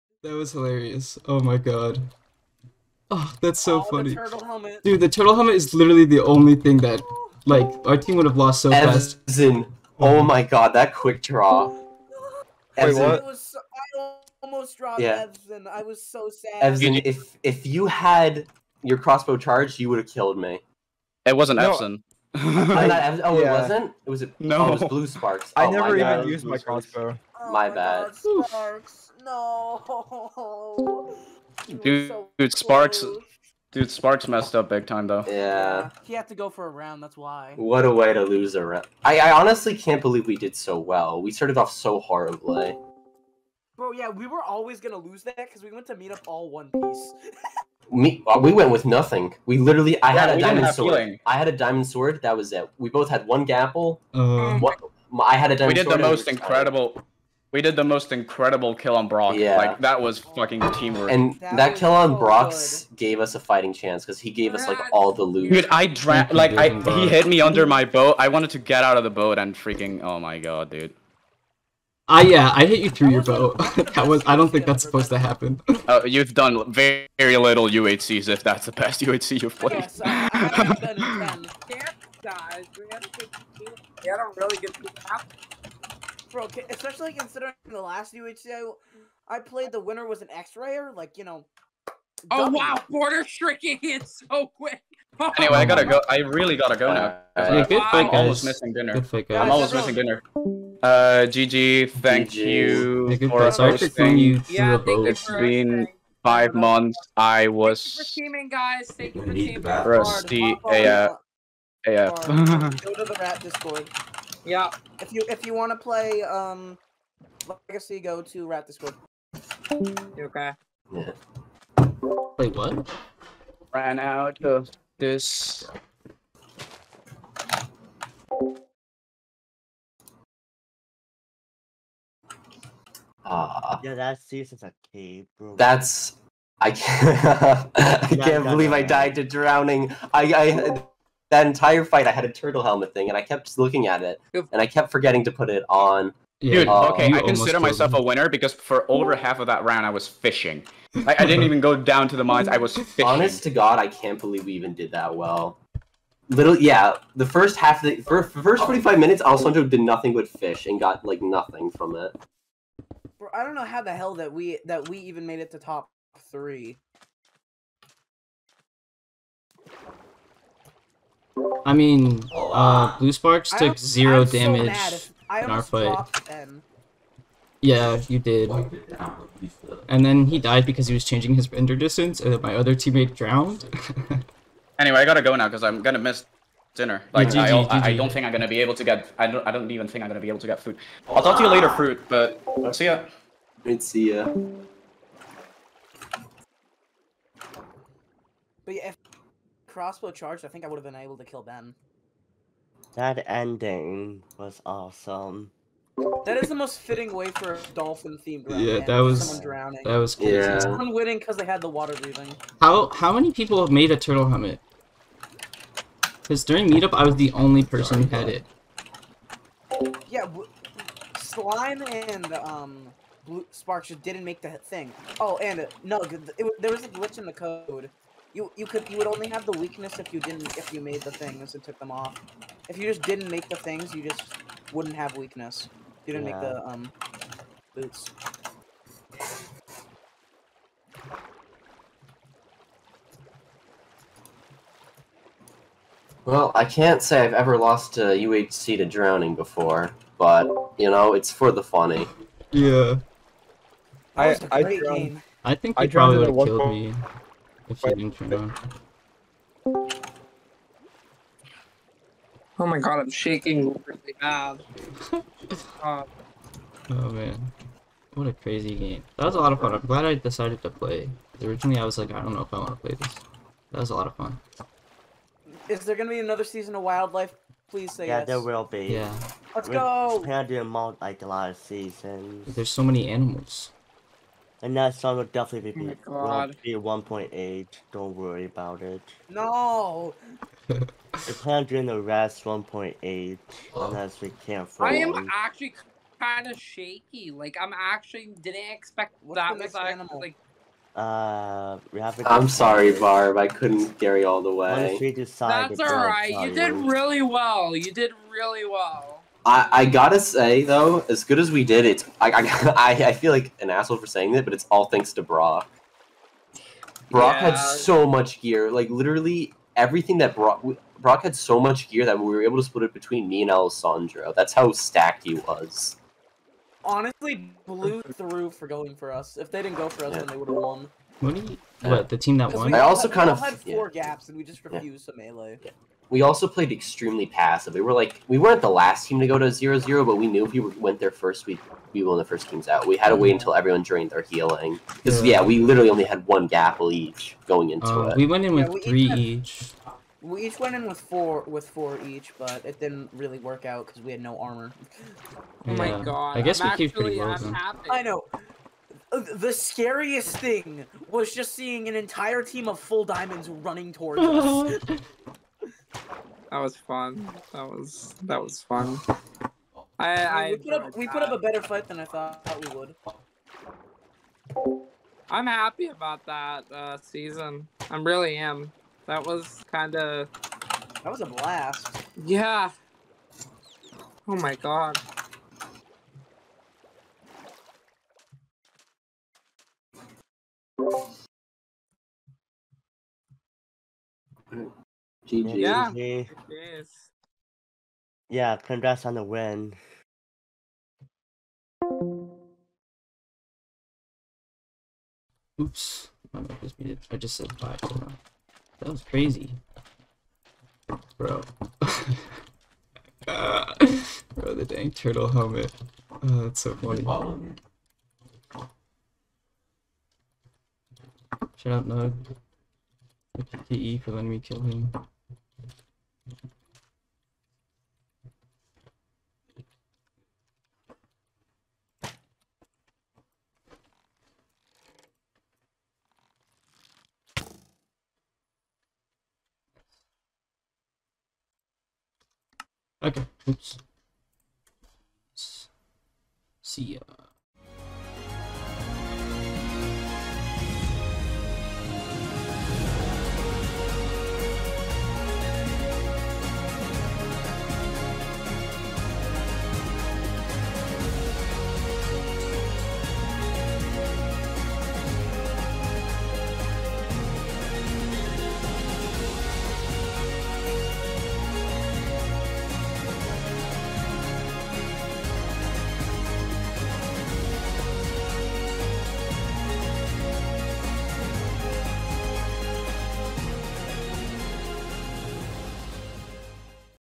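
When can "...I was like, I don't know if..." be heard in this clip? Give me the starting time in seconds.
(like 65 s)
271 s.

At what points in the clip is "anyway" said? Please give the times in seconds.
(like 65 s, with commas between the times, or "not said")
95 s, 184 s.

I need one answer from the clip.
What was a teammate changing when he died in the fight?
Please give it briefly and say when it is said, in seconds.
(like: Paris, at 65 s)
render distance, at 181 s.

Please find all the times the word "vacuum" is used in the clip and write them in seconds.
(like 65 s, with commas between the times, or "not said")
not said.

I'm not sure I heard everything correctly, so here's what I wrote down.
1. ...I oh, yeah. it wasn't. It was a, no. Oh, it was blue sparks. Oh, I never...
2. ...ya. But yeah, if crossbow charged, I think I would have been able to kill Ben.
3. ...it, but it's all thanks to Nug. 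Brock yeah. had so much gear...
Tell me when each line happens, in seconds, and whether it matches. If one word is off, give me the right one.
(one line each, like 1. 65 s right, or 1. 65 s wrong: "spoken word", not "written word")
1. 22 s right
2. 194 s right
3. 314 s wrong: "Brock", not "Nug".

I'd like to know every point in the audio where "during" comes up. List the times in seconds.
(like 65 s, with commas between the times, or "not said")
216 s, 291 s.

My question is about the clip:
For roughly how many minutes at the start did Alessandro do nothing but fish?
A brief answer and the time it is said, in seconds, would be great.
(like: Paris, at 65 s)
45, at 158 s.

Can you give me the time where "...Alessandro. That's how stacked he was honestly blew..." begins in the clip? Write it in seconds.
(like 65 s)
323 s.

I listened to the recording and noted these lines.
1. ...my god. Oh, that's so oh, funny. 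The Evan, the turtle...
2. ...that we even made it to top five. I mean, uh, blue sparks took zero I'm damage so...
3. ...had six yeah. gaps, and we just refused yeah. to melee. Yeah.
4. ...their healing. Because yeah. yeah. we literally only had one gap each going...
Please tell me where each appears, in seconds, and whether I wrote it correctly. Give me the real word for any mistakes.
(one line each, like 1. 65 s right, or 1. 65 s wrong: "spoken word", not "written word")
1. 1 s wrong: "Dude", not "Evan"
2. 164 s wrong: "three", not "five"
3. 333 s wrong: "four", not "six"
4. 344 s right.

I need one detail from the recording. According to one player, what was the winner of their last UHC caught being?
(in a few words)
X-rayer.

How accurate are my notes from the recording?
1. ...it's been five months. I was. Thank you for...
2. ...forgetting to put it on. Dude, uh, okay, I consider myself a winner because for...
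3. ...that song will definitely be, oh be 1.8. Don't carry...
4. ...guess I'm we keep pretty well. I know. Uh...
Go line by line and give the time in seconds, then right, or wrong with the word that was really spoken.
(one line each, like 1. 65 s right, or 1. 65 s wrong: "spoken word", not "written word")
1. 104 s right
2. 144 s right
3. 284 s wrong: "worry", not "carry"
4. 356 s right.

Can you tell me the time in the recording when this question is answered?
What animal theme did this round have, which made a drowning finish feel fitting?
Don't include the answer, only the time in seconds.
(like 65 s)
207 s.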